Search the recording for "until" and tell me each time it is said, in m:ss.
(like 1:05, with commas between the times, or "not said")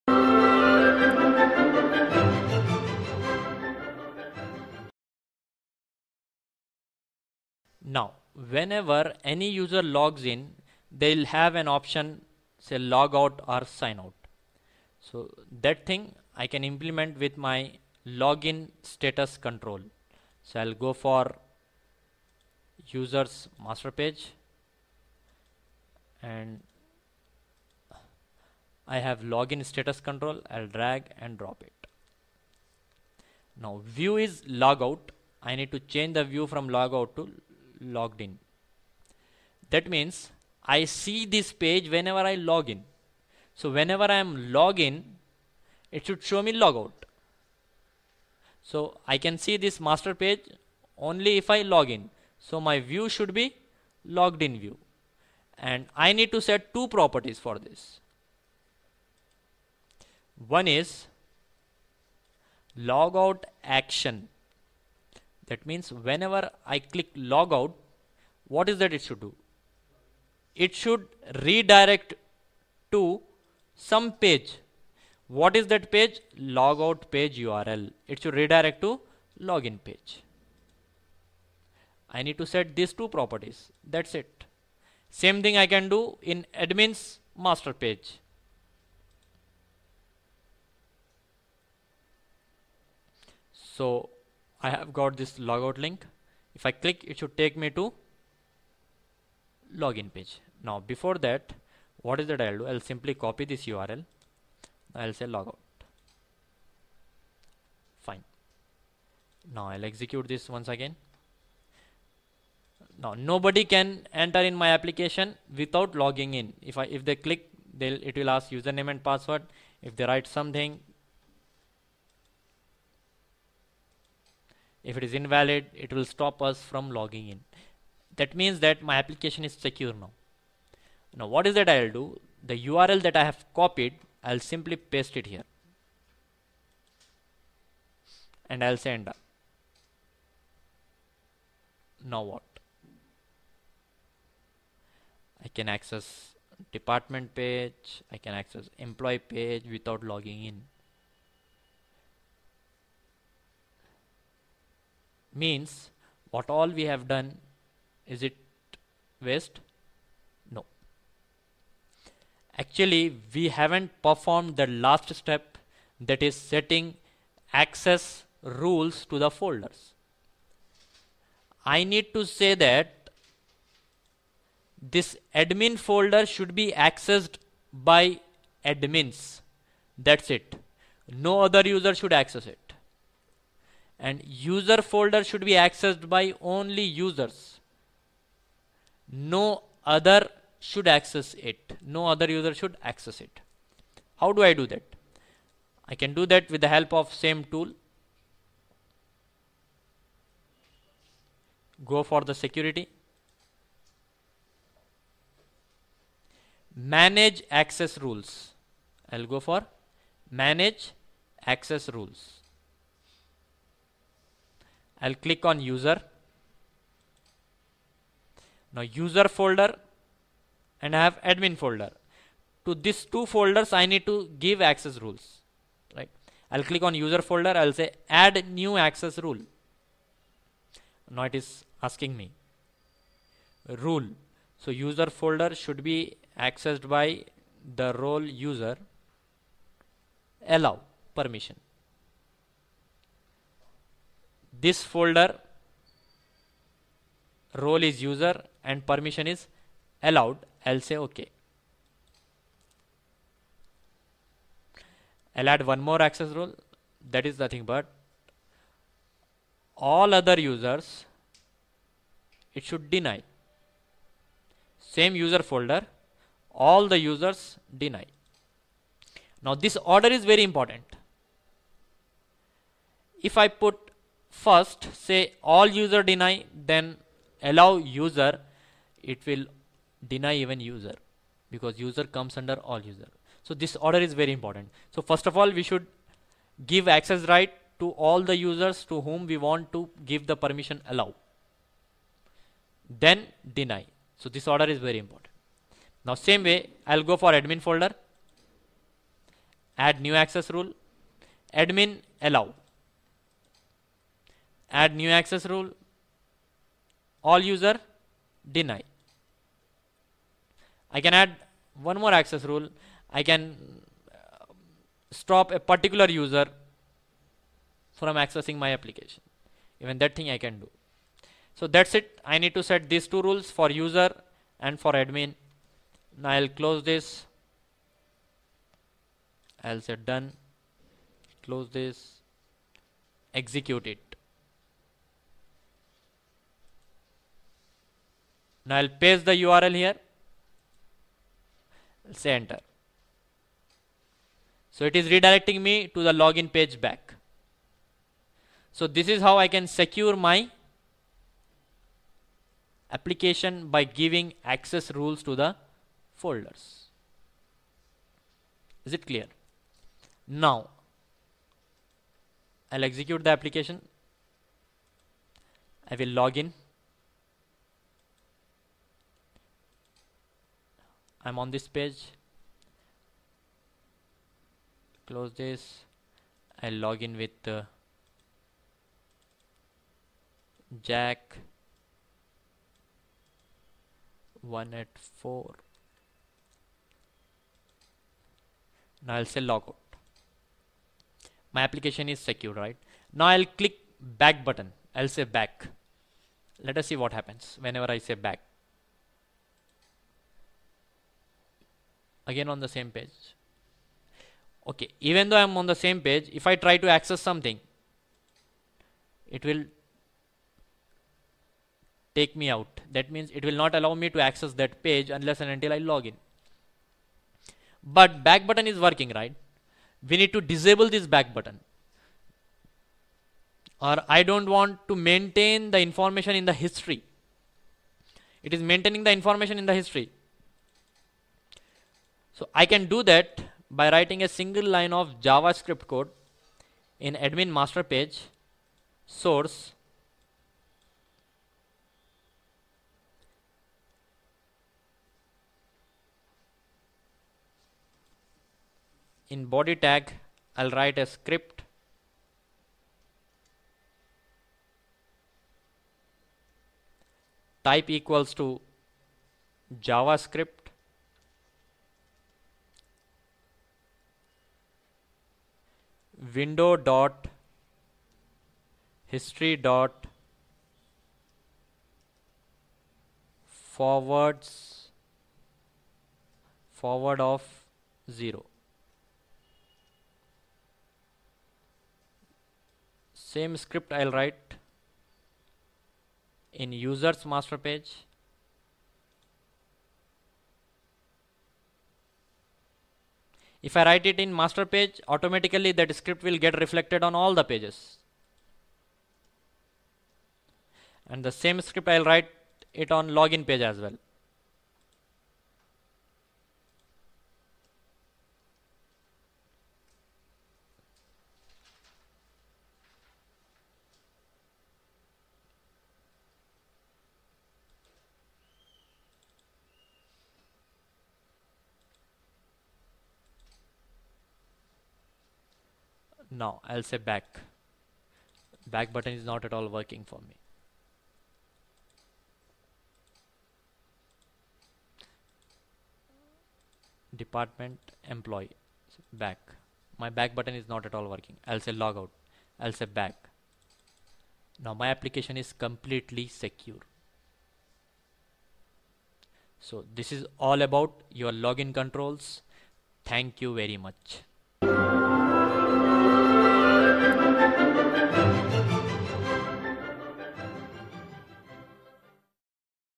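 6:55.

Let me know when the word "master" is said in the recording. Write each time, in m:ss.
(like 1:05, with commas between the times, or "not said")
0:23, 0:49, 1:27, 7:17, 8:07, 8:14.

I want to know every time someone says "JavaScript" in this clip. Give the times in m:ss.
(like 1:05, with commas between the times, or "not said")
7:15, 7:39.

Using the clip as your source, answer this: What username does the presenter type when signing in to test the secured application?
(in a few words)
jack 1.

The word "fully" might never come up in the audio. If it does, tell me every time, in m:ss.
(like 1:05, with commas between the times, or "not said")
not said.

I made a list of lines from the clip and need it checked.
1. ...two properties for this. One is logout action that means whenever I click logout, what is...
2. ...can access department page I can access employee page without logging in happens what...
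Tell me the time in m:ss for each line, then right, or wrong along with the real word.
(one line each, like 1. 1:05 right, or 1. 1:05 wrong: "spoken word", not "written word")
1. 0:56 right
2. 2:25 wrong: "means", not "happens".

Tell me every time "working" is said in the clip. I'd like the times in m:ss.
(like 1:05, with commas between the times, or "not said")
6:58, 8:49, 9:01.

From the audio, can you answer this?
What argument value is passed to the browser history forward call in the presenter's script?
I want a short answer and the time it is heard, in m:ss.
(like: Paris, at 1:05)
0, at 7:58.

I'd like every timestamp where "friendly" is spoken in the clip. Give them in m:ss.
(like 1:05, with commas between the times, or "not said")
not said.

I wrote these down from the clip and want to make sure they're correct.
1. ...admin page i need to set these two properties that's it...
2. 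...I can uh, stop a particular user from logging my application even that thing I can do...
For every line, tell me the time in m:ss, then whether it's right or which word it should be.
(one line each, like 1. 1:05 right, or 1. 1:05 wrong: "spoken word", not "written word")
1. 1:19 wrong: "login", not "admin"
2. 5:13 wrong: "accessing", not "logging".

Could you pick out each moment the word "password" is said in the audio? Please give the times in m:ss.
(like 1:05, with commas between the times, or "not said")
1:59.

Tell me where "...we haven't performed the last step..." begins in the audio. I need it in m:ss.
2:43.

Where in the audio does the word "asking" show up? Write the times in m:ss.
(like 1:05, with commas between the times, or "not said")
3:51.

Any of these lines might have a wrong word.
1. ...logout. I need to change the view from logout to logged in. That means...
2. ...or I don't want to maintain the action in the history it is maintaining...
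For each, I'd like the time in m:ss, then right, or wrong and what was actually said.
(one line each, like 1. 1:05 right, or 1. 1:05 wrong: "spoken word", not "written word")
1. 0:34 right
2. 7:03 wrong: "information", not "action".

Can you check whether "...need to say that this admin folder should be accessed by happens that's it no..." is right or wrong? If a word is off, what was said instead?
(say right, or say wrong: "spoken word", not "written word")
wrong: "admins", not "happens".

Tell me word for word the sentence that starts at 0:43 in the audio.
So whenever I am log in, it should show me logout.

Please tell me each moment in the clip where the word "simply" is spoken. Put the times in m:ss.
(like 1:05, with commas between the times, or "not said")
1:42, 2:14.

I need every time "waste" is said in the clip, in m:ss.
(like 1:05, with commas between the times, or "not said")
2:39.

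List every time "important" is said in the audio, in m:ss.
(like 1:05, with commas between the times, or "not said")
4:30, 4:44, 4:54.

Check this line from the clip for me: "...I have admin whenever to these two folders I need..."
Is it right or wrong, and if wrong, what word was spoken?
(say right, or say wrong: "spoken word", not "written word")
wrong: "folder", not "whenever".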